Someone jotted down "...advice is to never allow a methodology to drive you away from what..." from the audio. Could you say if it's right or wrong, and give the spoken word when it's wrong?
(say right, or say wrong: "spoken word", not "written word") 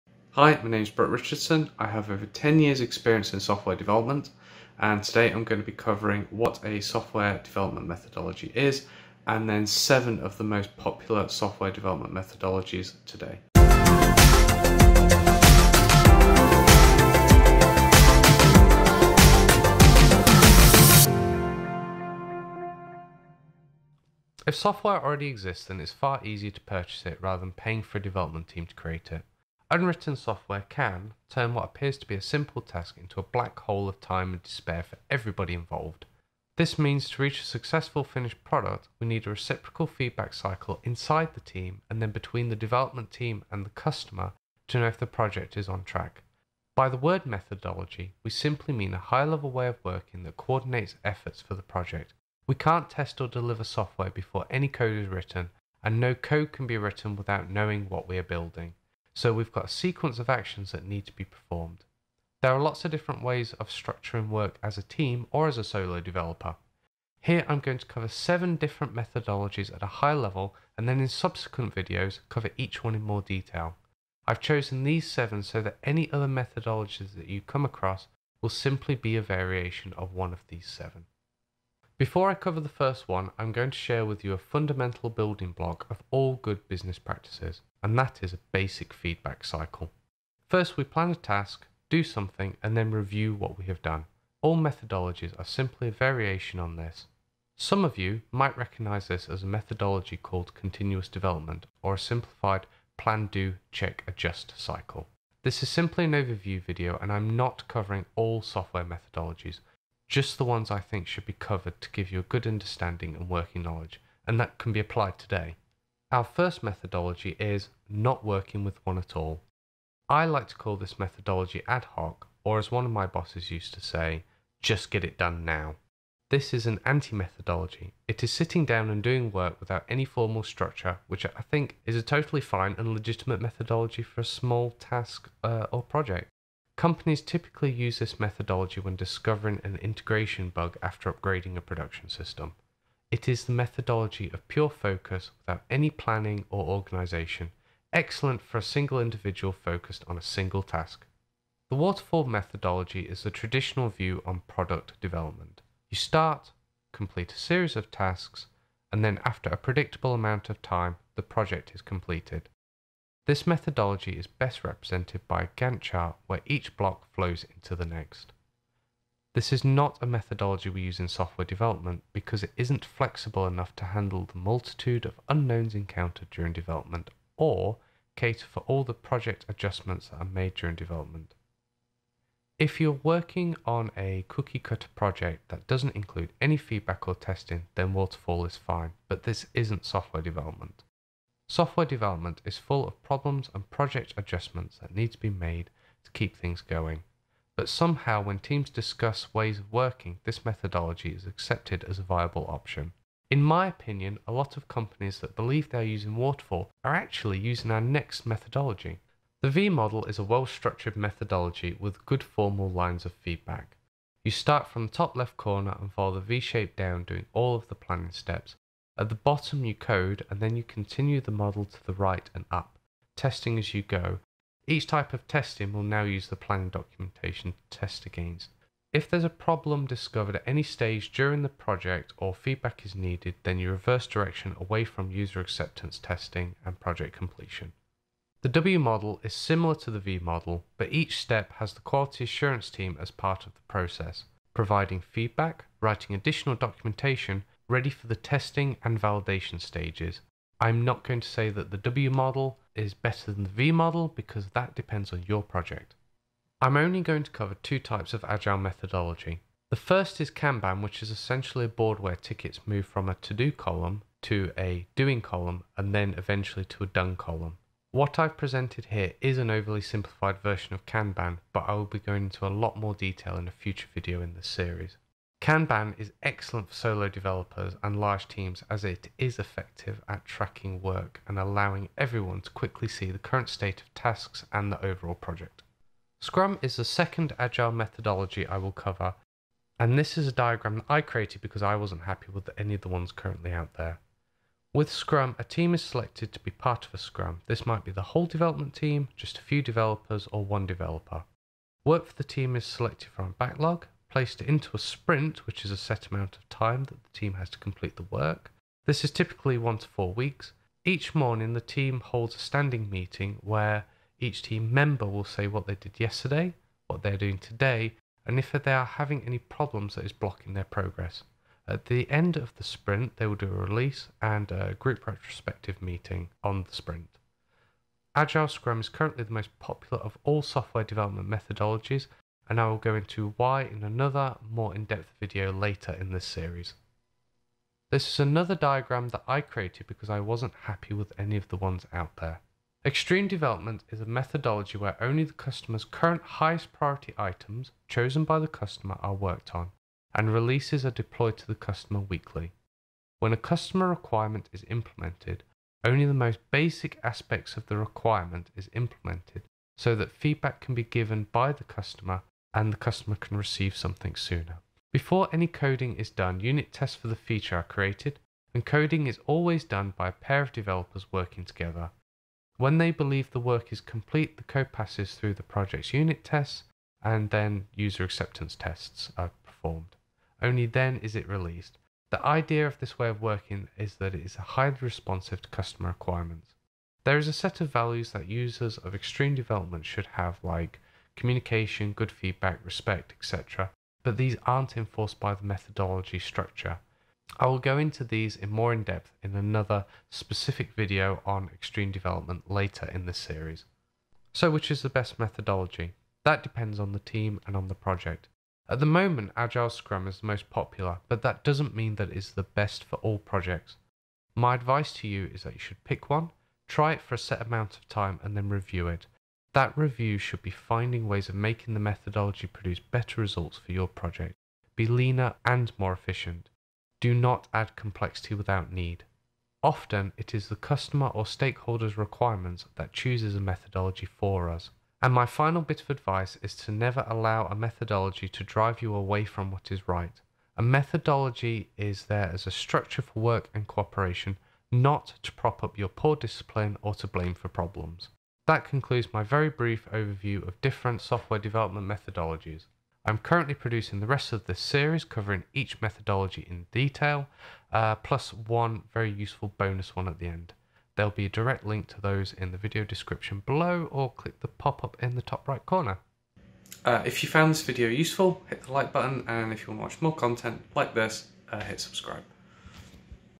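right.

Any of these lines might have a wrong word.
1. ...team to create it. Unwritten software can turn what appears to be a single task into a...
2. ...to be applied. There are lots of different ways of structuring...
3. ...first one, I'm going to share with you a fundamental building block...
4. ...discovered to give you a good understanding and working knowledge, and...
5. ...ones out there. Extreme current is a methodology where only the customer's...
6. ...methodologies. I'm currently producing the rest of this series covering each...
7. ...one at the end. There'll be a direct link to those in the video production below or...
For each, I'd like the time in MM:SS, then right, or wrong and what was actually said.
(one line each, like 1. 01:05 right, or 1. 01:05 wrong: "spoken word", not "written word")
1. 00:28 wrong: "simple", not "single"
2. 01:01 wrong: "performed", not "applied"
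3. 01:22 right
4. 01:51 wrong: "covered", not "discovered"
5. 05:41 wrong: "development", not "current"
6. 07:31 right
7. 07:39 wrong: "description", not "production".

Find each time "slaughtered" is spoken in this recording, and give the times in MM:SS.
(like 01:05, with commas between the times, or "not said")
not said.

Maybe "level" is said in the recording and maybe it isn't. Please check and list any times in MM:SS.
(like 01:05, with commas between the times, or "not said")
00:49, 01:10.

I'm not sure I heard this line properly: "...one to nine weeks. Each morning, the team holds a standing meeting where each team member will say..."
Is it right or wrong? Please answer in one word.
wrong.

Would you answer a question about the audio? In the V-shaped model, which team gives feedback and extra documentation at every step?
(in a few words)
quality assurance.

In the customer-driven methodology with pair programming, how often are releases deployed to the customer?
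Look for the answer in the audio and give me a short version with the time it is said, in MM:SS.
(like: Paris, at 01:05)
weekly, at 05:52.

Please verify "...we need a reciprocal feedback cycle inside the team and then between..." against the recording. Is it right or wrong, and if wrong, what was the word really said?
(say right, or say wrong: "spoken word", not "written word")
right.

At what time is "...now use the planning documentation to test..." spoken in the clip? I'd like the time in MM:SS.
03:45.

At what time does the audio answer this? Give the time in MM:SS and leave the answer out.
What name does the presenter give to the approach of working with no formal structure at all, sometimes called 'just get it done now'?
02:01.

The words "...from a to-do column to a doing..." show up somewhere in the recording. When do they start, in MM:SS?
04:22.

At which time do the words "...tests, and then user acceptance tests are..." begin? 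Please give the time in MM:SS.
06:16.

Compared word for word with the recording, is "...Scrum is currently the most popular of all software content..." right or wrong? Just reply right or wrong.
wrong.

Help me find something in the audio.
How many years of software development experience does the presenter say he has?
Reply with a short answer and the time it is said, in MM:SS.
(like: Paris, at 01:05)
10, at 00:02.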